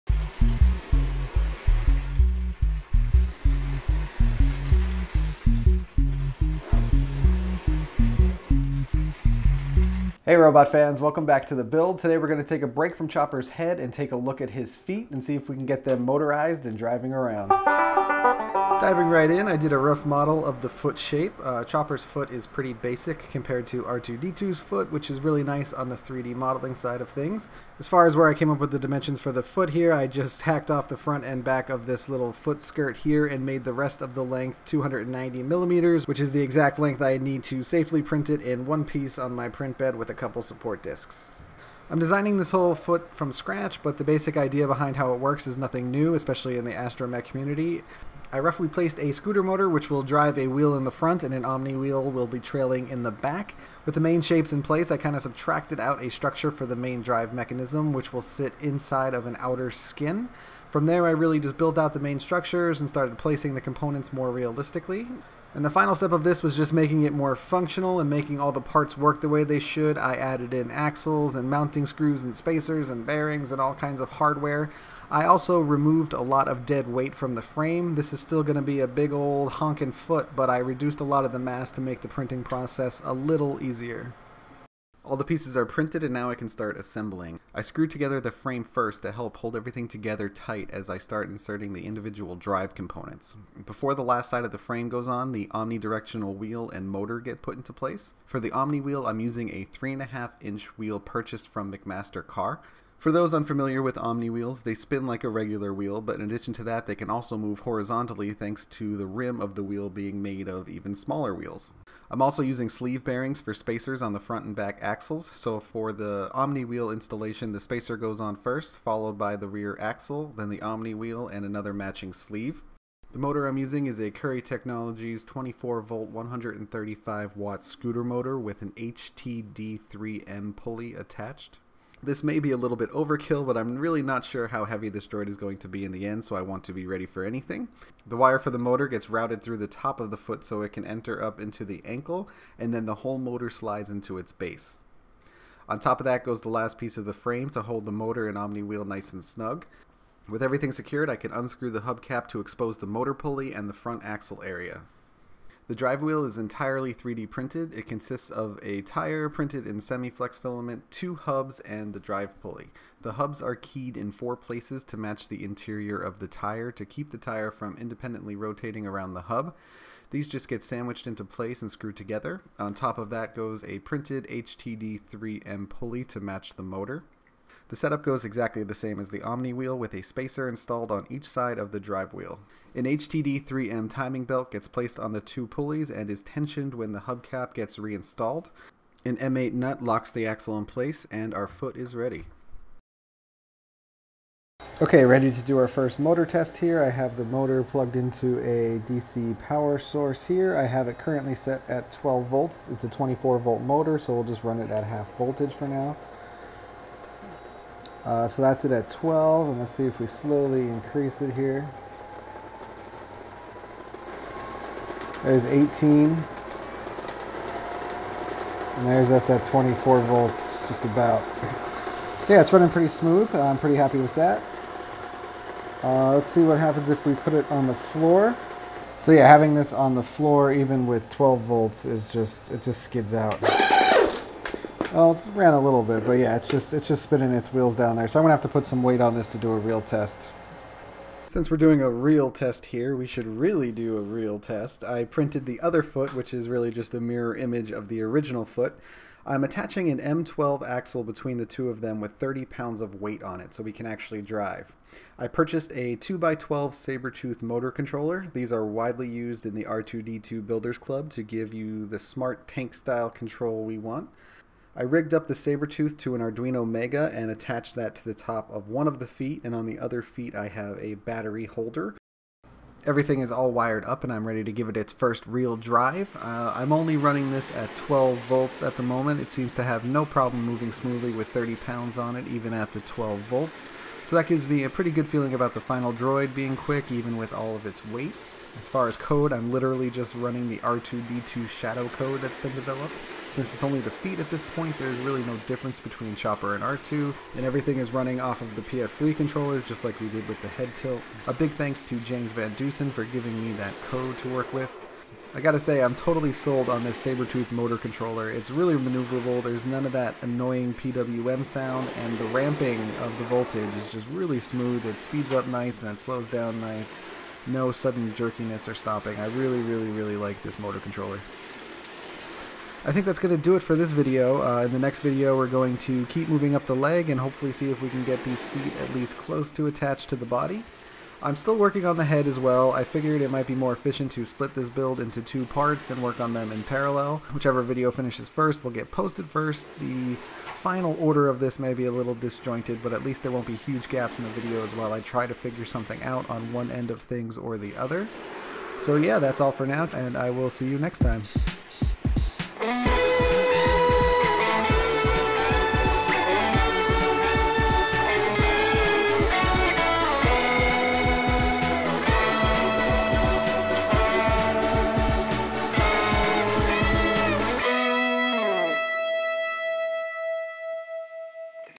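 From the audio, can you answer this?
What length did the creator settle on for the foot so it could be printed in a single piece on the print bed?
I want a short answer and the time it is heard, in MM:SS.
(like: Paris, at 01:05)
290 millimeters, at 00:34.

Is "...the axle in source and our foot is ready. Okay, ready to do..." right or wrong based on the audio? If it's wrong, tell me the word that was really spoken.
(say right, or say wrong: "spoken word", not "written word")
wrong: "place", not "source".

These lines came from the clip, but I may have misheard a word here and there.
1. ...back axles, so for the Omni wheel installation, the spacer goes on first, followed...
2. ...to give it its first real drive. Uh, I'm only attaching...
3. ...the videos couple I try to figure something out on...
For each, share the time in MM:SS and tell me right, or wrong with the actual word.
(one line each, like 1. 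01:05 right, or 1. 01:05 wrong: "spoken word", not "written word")
1. 01:54 right
2. 04:34 wrong: "running", not "attaching"
3. 05:44 wrong: "while", not "couple".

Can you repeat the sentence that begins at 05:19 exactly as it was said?
I really, really, really like this motor controller.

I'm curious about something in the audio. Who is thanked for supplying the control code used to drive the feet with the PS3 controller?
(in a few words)
James Van Dusen.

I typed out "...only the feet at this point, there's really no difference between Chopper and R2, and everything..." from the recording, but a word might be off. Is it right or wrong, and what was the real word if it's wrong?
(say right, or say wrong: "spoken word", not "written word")
right.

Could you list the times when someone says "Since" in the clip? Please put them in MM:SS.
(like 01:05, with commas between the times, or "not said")
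04:01, 04:53.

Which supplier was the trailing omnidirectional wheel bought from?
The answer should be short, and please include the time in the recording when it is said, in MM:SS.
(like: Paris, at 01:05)
McMaster Carr, at 01:41.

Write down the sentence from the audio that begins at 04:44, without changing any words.
So that gives me a pretty good feeling about the final droid being quick, even with all of its weight.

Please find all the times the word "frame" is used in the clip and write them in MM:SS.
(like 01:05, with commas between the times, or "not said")
01:17, 01:28, 01:34, 02:27.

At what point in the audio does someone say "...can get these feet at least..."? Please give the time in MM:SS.
05:27.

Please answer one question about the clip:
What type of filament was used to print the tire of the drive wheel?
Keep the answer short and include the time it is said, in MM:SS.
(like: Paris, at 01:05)
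semi-flex, at 02:39.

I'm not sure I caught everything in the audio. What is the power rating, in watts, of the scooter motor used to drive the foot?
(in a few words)
135 watts.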